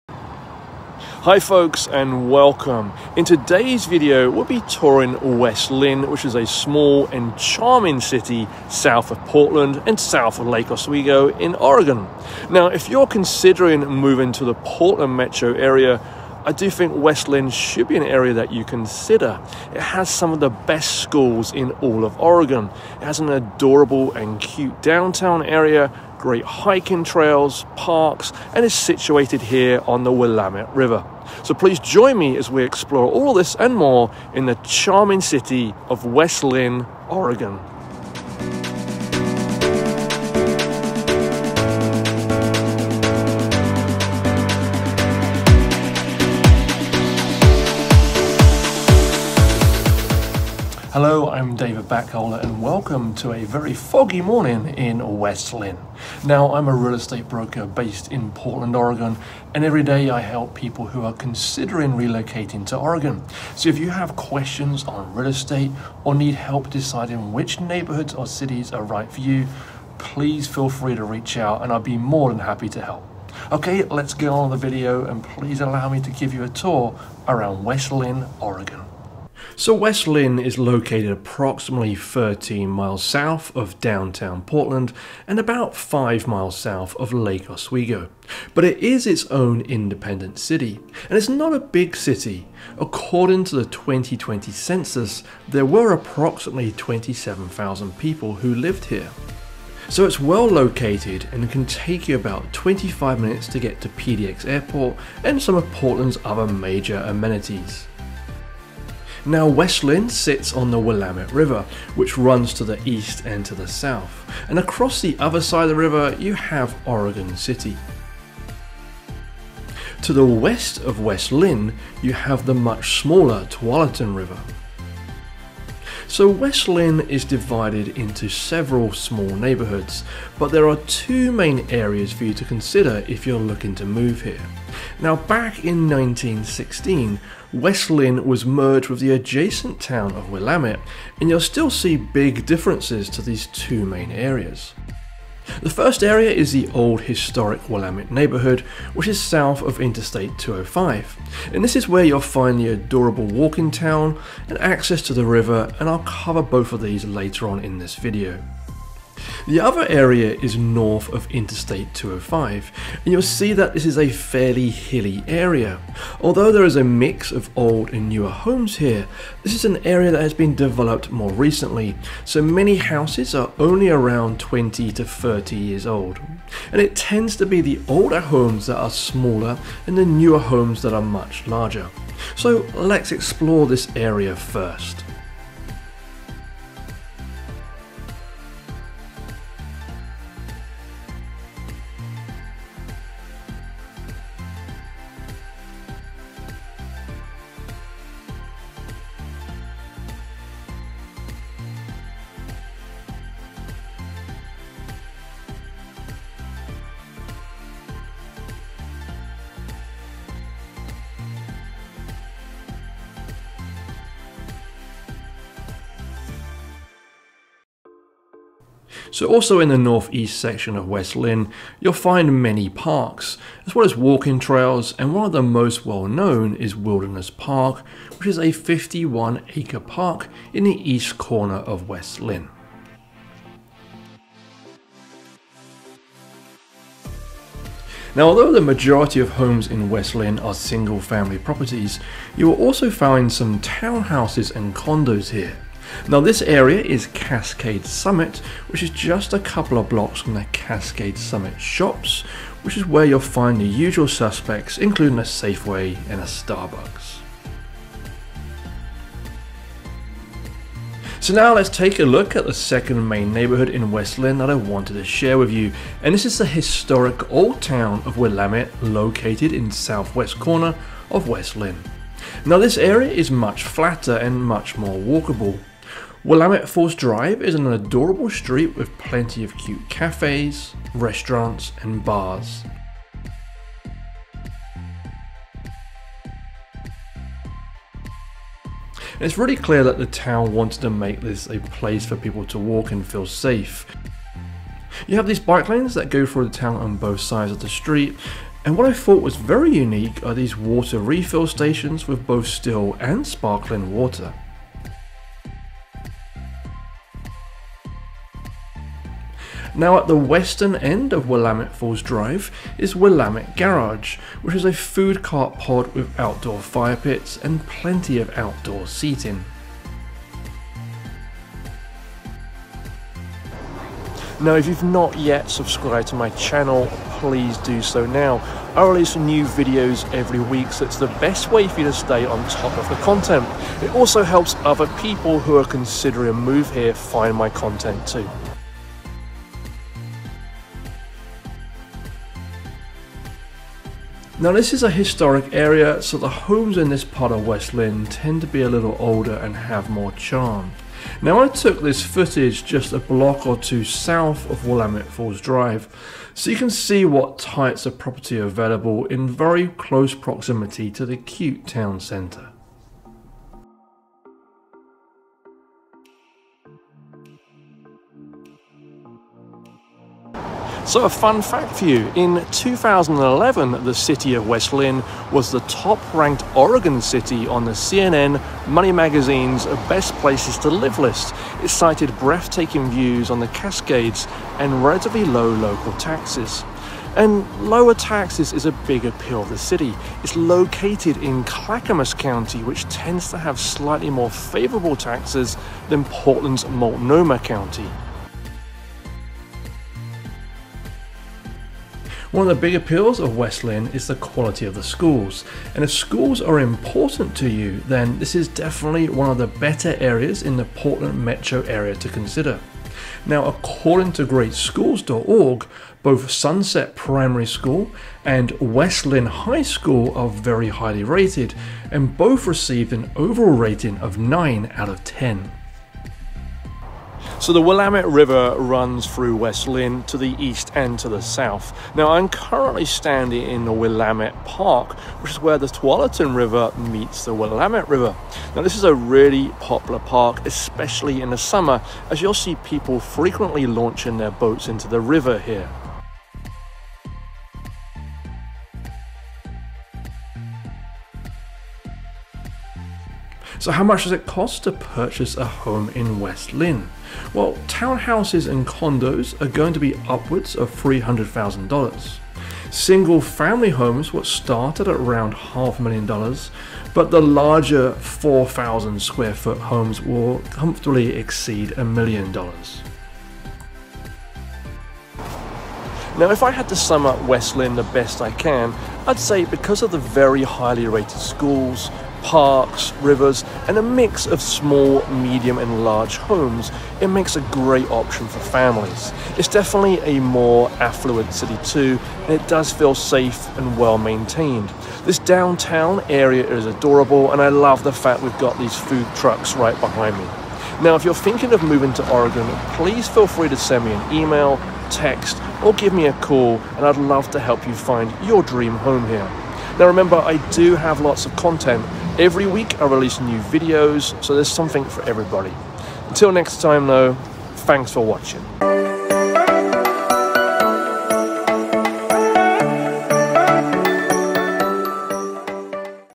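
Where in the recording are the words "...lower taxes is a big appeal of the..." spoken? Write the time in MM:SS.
06:27.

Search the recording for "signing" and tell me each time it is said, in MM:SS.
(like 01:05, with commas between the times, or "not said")
not said.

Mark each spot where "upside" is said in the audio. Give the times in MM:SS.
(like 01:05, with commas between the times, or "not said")
not said.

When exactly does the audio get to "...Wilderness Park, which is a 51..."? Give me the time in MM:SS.
03:46.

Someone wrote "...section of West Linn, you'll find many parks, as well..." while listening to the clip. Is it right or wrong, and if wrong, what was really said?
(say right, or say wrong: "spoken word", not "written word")
right.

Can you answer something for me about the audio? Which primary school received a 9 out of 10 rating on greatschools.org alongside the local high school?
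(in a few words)
Sunset Primary School.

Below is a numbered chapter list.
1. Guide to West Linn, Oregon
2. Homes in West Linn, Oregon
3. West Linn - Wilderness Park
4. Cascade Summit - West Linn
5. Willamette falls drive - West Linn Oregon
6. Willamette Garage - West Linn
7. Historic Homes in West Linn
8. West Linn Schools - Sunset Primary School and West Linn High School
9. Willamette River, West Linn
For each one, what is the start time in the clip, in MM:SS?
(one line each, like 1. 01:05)
1. 01:17
2. 02:47
3. 03:34
4. 04:00
5. 04:24
6. 05:12
7. 05:40
8. 06:40
9. 07:05.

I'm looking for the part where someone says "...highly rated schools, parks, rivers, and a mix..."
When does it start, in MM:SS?
08:00.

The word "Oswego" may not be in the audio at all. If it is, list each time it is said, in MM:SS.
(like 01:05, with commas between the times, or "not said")
00:10, 01:27.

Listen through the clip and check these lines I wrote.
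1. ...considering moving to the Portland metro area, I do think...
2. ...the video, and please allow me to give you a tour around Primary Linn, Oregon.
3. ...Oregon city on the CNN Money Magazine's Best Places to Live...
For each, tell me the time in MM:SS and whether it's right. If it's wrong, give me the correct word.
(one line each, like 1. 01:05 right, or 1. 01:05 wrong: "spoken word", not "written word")
1. 00:13 right
2. 01:14 wrong: "West", not "Primary"
3. 06:16 right.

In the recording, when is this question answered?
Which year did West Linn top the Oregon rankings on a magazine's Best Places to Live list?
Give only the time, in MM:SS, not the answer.
06:12.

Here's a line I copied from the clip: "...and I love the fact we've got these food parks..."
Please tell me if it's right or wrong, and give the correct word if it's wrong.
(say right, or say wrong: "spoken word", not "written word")
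wrong: "trucks", not "parks".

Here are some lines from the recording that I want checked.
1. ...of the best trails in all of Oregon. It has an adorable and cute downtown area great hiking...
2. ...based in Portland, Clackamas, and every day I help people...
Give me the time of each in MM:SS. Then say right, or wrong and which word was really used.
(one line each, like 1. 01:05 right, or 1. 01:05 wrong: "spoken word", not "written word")
1. 00:20 wrong: "schools", not "trails"
2. 00:57 wrong: "Oregon", not "Clackamas".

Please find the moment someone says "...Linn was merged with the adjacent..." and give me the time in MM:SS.
02:17.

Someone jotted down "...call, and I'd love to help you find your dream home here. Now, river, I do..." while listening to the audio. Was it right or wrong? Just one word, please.
wrong.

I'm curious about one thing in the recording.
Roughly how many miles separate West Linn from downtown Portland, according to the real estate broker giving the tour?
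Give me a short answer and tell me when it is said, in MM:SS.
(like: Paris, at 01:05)
13, at 01:21.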